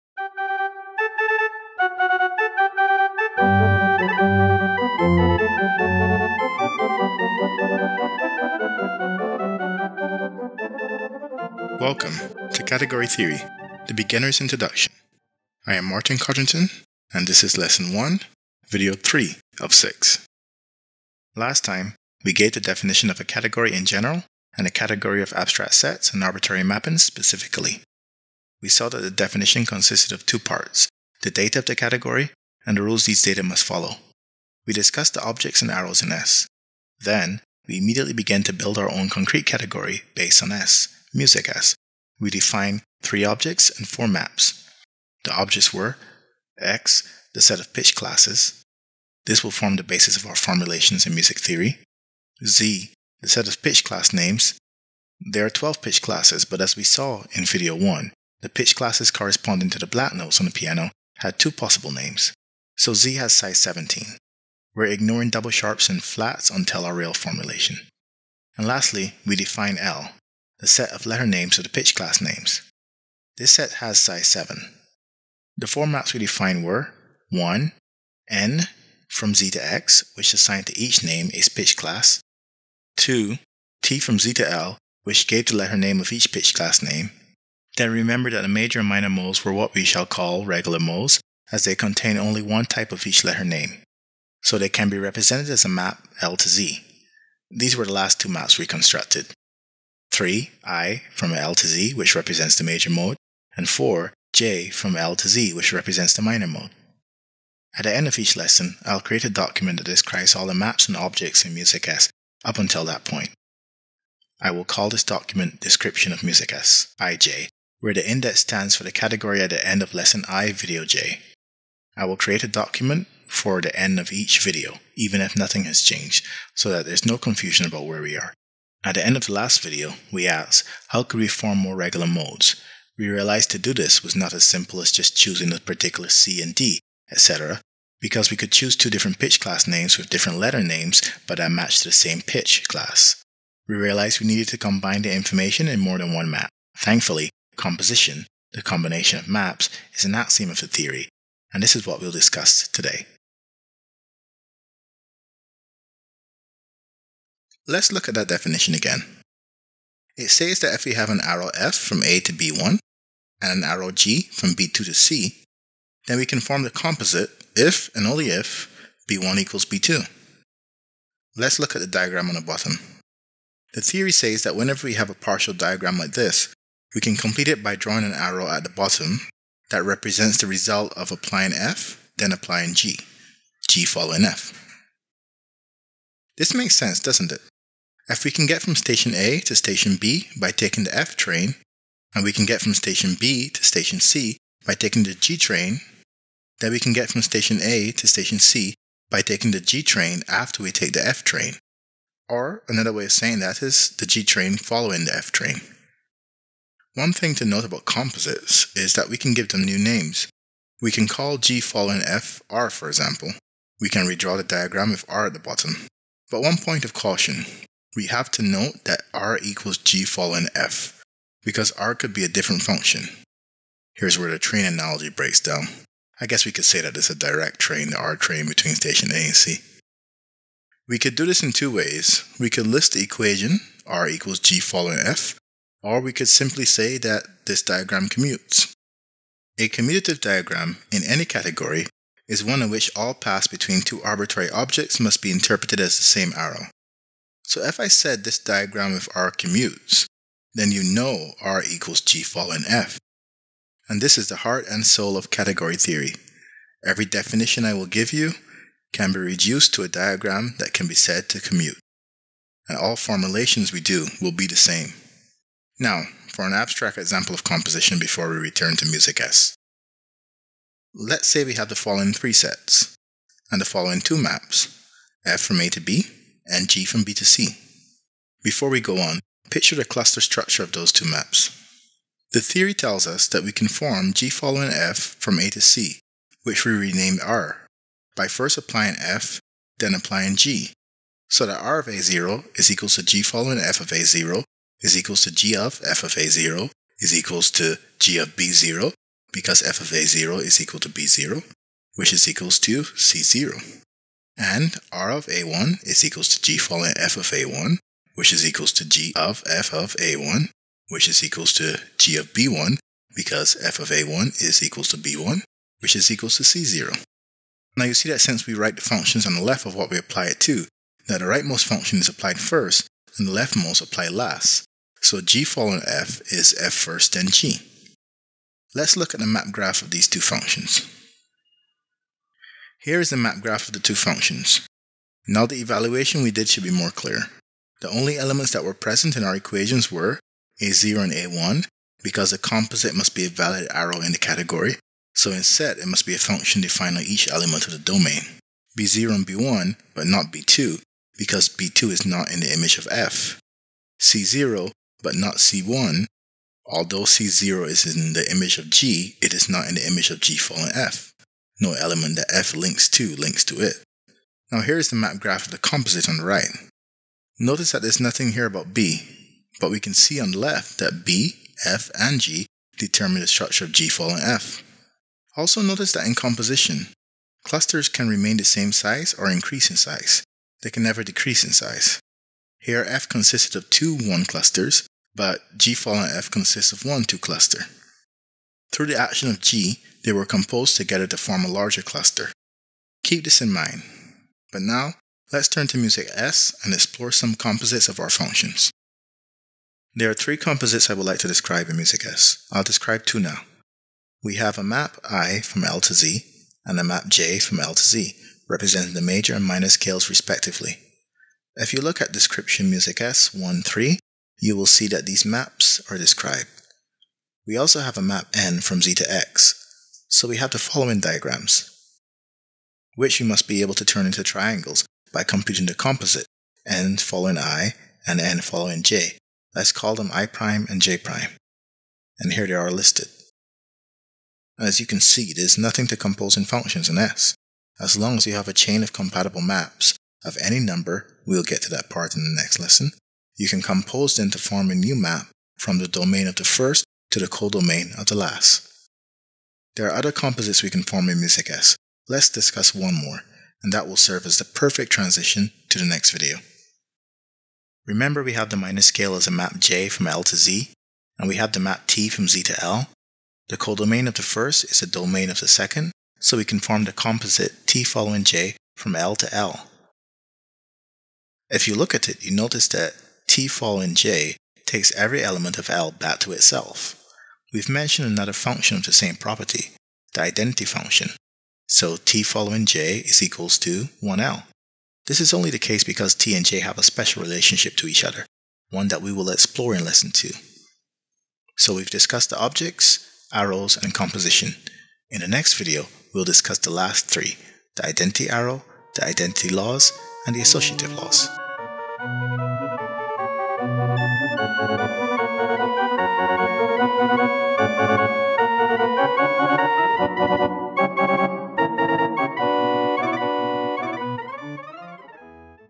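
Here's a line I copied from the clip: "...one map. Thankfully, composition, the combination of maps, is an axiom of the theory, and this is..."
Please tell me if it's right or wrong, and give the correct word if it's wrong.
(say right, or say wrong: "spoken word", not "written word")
right.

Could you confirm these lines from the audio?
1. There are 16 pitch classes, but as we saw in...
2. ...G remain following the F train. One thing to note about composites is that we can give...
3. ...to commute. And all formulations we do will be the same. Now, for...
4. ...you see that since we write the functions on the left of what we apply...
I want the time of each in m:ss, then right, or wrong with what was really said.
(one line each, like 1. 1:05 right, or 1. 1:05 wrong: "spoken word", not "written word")
1. 0:55 wrong: "12", not "16"
2. 3:24 wrong: "train", not "remain"
3. 4:21 right
4. 5:17 right.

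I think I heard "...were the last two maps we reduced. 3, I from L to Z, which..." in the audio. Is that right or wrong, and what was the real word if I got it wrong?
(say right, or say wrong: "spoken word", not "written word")
wrong: "constructed", not "reduced".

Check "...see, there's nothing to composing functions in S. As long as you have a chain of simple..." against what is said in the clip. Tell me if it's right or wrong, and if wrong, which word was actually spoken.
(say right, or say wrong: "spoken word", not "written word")
wrong: "compatible", not "simple".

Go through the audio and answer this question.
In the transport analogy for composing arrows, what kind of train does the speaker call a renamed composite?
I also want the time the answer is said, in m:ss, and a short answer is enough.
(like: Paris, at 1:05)
direct train, at 3:47.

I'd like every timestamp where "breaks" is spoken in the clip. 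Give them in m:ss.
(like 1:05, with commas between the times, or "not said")
3:45.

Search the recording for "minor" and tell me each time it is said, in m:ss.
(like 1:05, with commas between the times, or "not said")
1:28, 1:46, 6:49, 7:38.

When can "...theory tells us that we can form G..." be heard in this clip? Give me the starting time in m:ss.
4:42.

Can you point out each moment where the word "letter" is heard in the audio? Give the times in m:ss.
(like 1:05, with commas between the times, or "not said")
1:11, 1:25, 1:33, 2:20.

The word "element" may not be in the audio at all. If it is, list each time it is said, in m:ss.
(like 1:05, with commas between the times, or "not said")
5:38, 5:47, 6:01, 7:55.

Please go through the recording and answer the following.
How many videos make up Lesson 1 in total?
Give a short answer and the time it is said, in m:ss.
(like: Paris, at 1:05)
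6, at 0:19.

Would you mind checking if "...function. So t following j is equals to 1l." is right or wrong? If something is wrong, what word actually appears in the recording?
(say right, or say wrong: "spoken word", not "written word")
right.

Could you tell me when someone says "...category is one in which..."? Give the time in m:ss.
4:01.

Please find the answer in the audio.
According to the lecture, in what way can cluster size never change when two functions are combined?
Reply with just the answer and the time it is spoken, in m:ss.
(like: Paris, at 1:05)
decrease, at 6:21.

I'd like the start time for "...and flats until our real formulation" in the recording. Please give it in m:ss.
1:05.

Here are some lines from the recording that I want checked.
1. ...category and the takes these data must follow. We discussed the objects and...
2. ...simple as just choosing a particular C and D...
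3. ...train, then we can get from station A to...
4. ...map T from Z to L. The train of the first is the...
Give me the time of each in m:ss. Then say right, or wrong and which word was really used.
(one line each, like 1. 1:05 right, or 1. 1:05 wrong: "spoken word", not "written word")
1. 0:31 wrong: "rules", not "takes"
2. 2:14 right
3. 3:15 right
4. 7:41 wrong: "codomain", not "train".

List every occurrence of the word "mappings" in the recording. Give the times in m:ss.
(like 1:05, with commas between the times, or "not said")
0:26.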